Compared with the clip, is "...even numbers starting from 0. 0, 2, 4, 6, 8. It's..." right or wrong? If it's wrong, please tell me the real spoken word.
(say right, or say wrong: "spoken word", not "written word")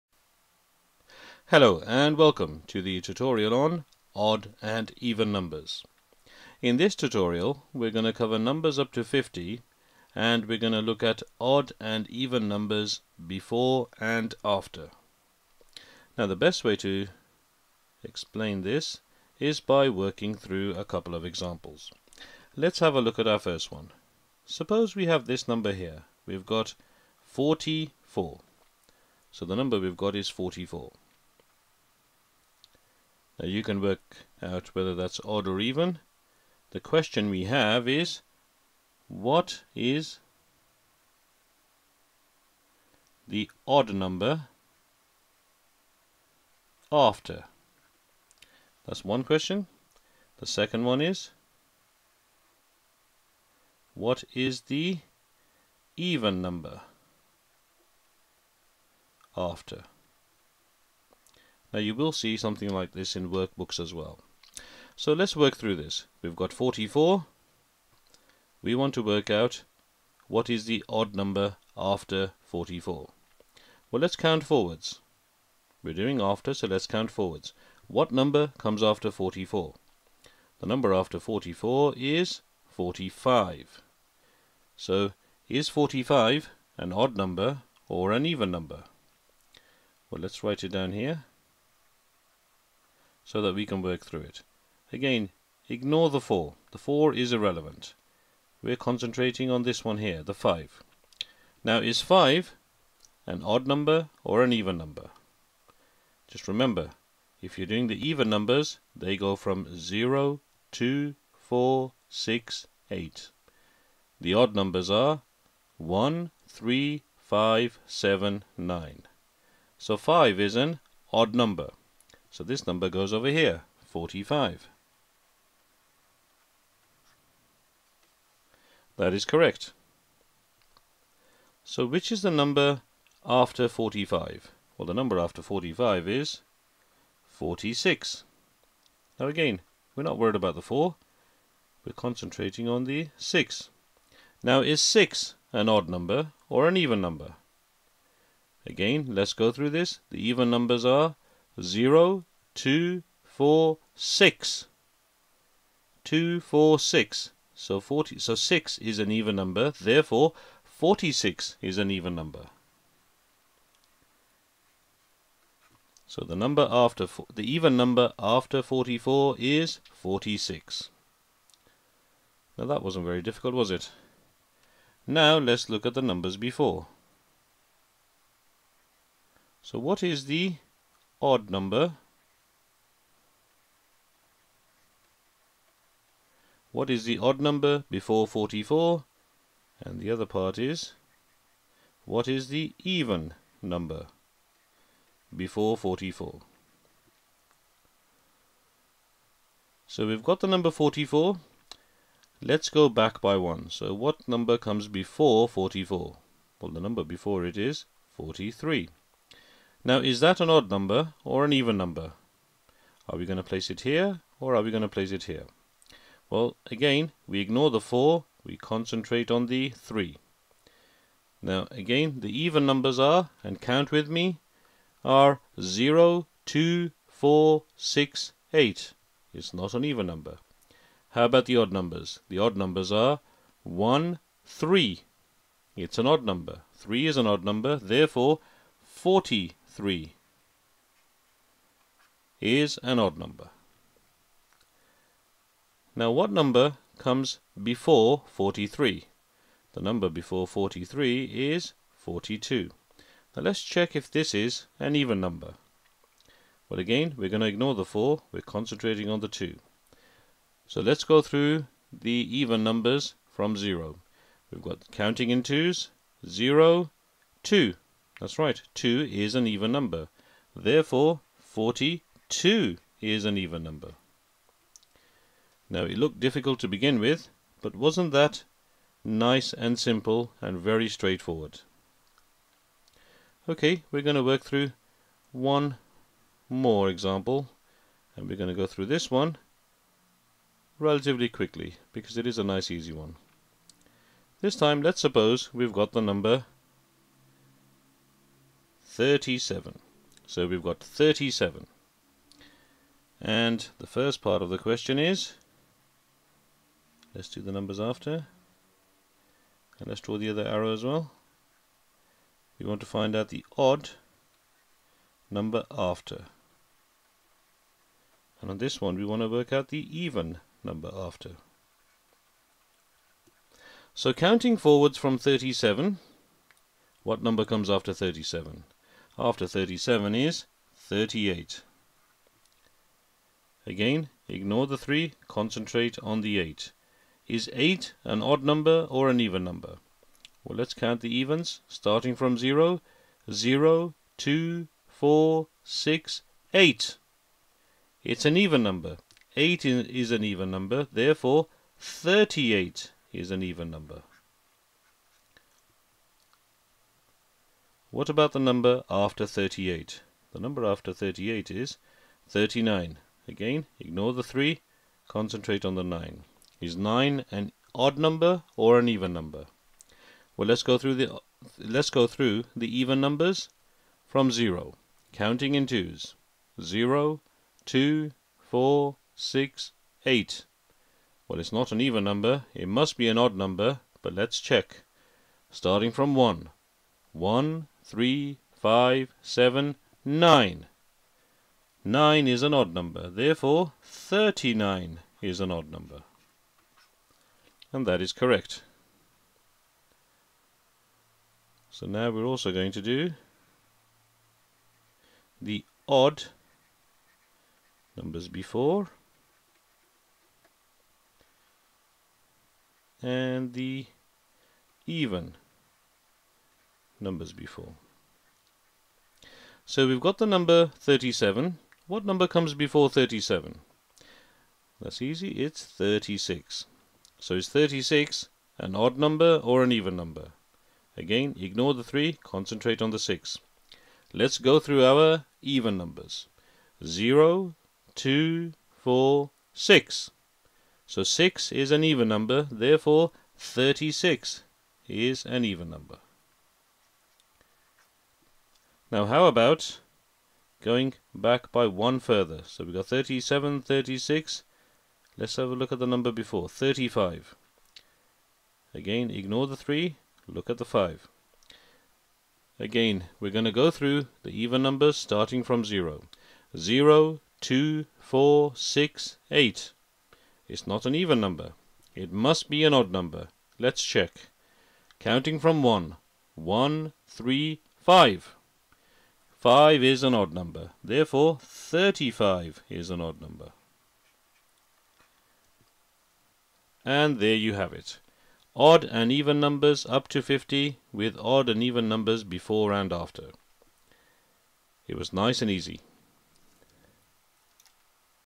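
right.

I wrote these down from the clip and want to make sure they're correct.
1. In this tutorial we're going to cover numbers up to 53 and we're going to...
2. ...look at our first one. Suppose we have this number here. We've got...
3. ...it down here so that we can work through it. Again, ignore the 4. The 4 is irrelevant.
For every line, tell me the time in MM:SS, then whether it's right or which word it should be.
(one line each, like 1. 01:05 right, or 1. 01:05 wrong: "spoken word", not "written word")
1. 00:06 wrong: "50", not "53"
2. 00:23 right
3. 01:30 right.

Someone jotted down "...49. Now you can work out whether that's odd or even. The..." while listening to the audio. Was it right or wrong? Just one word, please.
wrong.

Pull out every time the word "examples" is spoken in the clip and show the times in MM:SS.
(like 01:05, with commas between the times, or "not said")
00:21, 04:46.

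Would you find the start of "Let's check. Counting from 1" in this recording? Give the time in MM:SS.
07:53.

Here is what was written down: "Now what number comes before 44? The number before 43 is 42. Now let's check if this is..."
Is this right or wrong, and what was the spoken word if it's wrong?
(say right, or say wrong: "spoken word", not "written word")
wrong: "43", not "44".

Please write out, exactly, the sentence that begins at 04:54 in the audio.
This time let's suppose we've got the number 37.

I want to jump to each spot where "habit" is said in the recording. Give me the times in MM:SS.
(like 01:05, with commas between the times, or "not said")
not said.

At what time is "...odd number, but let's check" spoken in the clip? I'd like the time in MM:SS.
06:23.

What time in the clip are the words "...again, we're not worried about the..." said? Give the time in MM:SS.
02:19.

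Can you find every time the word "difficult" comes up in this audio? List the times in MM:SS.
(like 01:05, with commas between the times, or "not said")
02:53, 04:36.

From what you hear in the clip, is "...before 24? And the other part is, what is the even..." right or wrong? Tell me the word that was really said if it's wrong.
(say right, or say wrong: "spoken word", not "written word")
wrong: "44", not "24".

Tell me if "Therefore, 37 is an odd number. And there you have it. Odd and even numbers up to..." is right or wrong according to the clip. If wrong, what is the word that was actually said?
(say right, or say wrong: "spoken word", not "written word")
wrong: "35", not "37".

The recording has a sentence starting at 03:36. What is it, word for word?
Well, again, we ignore the 4, we concentrate on the 3.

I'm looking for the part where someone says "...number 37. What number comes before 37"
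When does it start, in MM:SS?
07:00.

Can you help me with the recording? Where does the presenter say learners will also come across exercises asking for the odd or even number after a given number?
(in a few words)
workbooks.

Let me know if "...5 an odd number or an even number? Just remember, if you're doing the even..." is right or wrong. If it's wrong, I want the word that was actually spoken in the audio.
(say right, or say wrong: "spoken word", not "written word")
right.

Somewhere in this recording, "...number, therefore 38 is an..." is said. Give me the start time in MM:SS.
05:50.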